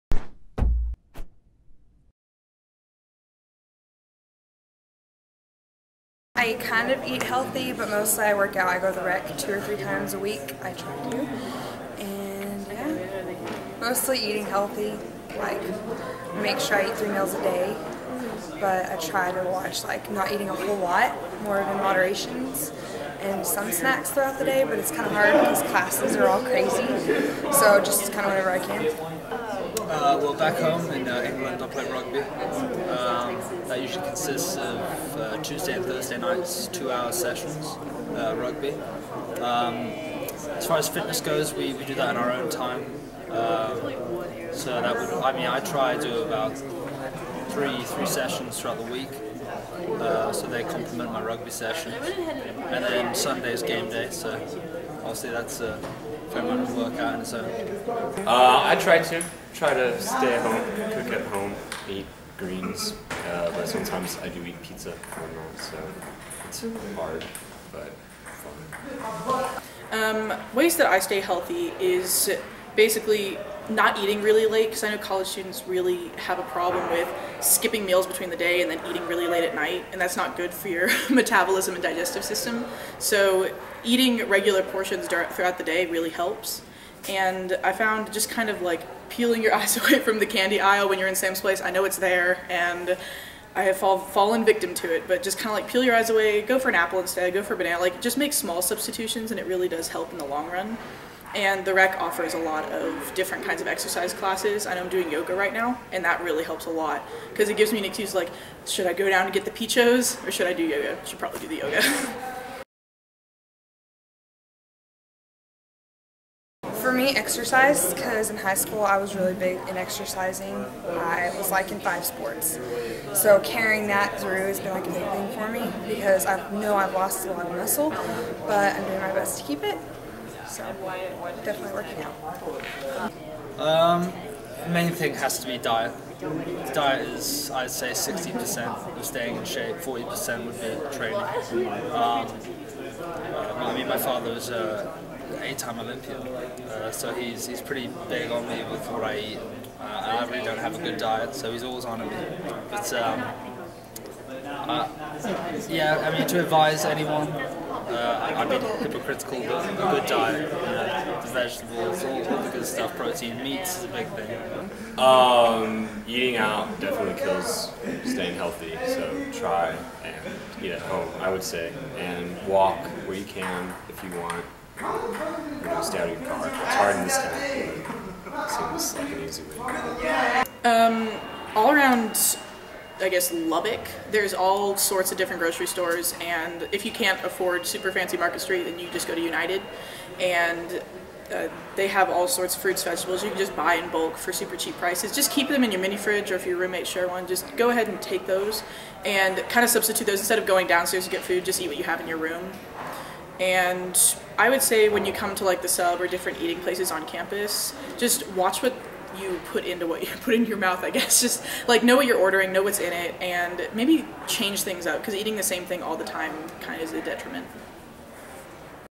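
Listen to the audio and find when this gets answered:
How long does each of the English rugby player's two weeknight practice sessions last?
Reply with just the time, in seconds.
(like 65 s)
36 s.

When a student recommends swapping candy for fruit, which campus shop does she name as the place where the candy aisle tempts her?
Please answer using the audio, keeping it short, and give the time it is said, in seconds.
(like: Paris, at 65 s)
Sam's Place, at 91 s.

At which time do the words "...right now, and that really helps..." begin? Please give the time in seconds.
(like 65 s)
105 s.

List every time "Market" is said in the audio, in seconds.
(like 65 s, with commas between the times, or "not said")
188 s.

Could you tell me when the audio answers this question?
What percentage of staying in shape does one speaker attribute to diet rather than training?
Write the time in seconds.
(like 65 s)
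137 s.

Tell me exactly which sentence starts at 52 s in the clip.
And then Sunday is game day, so obviously that's a fair amount of work out in its own.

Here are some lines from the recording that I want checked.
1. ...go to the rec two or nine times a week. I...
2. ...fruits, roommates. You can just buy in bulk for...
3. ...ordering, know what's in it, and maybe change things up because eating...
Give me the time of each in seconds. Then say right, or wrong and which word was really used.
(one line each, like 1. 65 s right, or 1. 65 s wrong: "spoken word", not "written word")
1. 8 s wrong: "three", not "nine"
2. 192 s wrong: "vegetables", not "roommates"
3. 212 s right.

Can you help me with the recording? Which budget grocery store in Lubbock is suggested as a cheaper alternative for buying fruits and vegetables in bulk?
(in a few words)
United.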